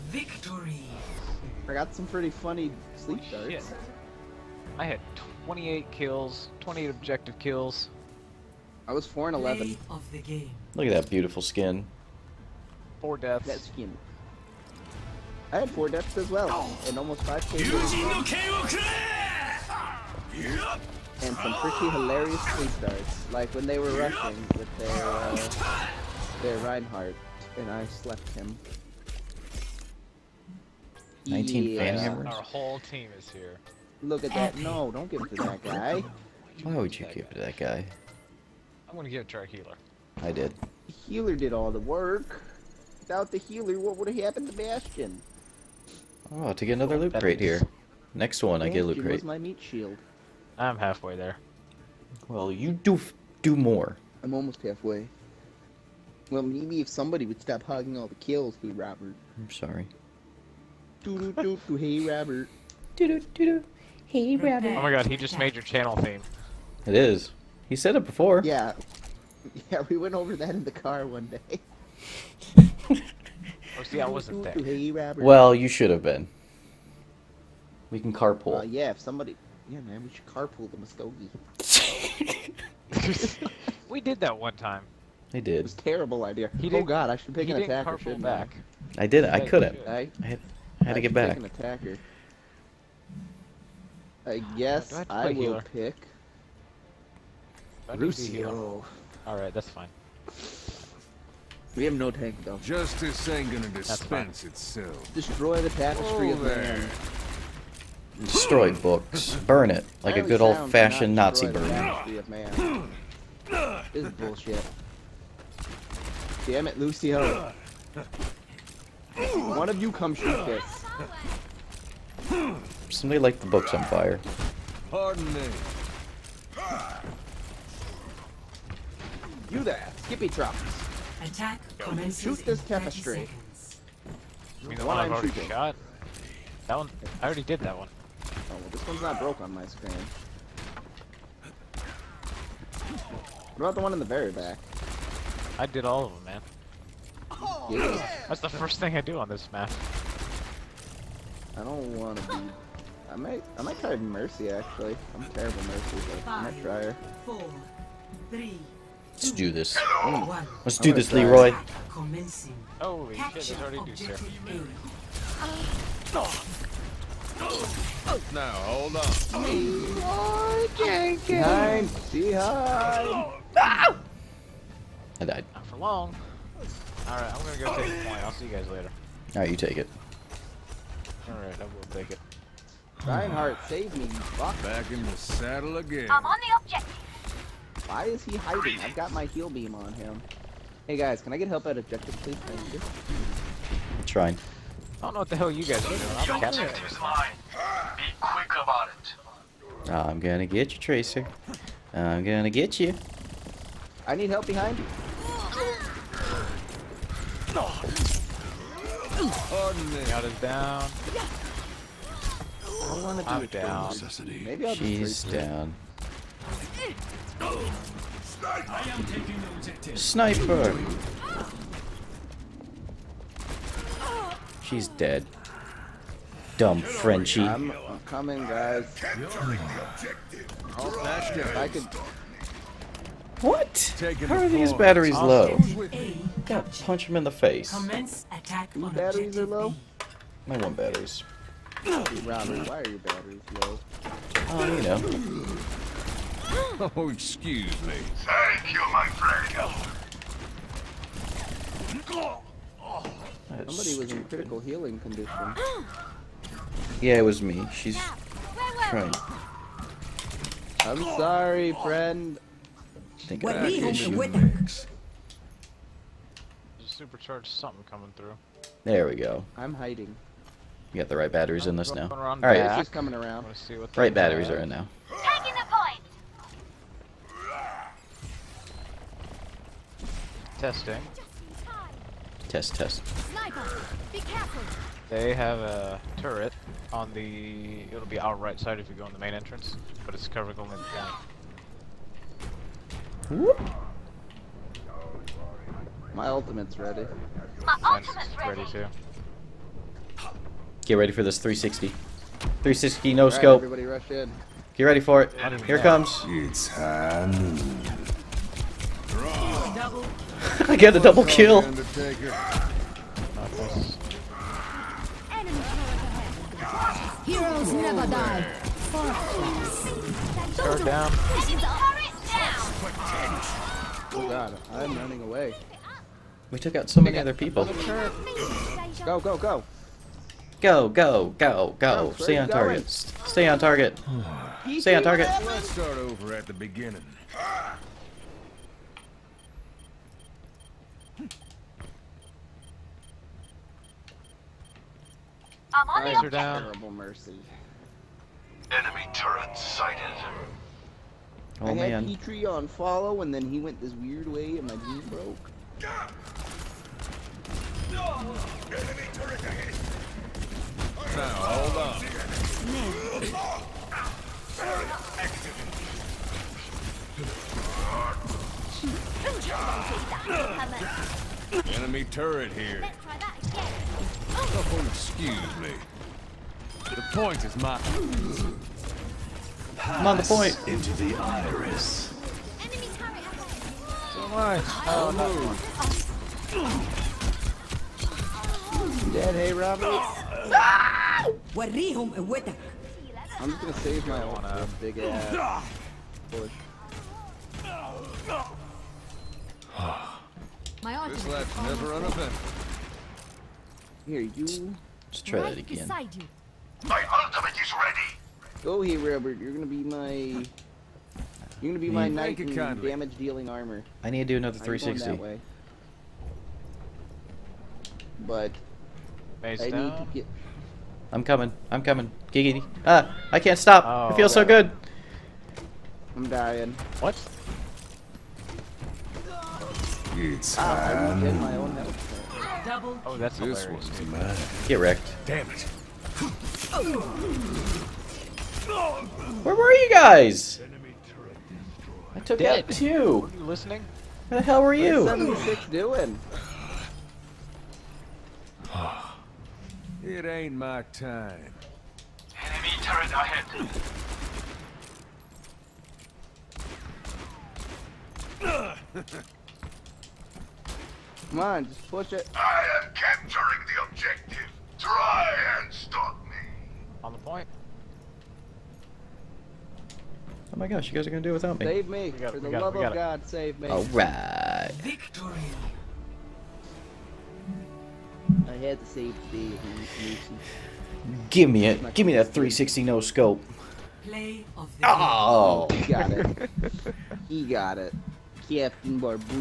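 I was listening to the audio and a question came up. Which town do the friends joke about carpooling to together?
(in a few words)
Muskogee.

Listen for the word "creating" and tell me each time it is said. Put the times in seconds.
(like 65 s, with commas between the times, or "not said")
not said.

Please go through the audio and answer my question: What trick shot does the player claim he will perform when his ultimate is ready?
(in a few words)
360 no scope.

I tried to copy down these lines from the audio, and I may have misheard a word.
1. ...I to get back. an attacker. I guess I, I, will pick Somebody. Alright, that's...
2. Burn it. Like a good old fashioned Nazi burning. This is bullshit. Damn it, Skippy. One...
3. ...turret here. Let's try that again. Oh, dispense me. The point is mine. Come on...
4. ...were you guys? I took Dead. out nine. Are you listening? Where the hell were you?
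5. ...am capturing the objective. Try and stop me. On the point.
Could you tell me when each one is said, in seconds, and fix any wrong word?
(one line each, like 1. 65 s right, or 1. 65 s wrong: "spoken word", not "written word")
1. 90 s wrong: "Lucio", not "Somebody"
2. 109 s wrong: "Lucio", not "Skippy"
3. 372 s wrong: "excuse", not "dispense"
4. 439 s wrong: "two", not "nine"
5. 462 s right.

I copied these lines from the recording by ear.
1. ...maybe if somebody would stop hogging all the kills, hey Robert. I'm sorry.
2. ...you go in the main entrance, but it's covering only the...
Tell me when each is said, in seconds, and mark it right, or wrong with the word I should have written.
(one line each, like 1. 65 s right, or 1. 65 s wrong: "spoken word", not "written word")
1. 56 s right
2. 288 s right.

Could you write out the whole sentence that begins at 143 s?
What about the one in the very back?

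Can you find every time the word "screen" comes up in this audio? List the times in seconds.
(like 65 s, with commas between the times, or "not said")
139 s.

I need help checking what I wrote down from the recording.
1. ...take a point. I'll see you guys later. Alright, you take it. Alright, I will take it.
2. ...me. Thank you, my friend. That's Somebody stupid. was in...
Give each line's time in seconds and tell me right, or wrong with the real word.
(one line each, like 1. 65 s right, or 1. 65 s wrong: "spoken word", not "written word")
1. 177 s right
2. 247 s right.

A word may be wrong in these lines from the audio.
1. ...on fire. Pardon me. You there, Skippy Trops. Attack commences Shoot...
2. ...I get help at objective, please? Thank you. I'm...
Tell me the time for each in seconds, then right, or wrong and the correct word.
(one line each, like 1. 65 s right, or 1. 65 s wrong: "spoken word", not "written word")
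1. 123 s right
2. 191 s right.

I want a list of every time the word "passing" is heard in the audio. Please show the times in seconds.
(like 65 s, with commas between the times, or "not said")
not said.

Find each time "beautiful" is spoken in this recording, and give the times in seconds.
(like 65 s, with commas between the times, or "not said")
11 s.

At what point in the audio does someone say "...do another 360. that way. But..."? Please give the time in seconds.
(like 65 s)
414 s.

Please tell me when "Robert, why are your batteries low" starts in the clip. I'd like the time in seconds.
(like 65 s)
241 s.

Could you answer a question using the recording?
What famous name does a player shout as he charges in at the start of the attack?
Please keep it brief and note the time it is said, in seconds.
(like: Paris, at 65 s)
Leroy Jenkins, at 169 s.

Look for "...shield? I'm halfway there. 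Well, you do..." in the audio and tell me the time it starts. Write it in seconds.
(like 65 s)
49 s.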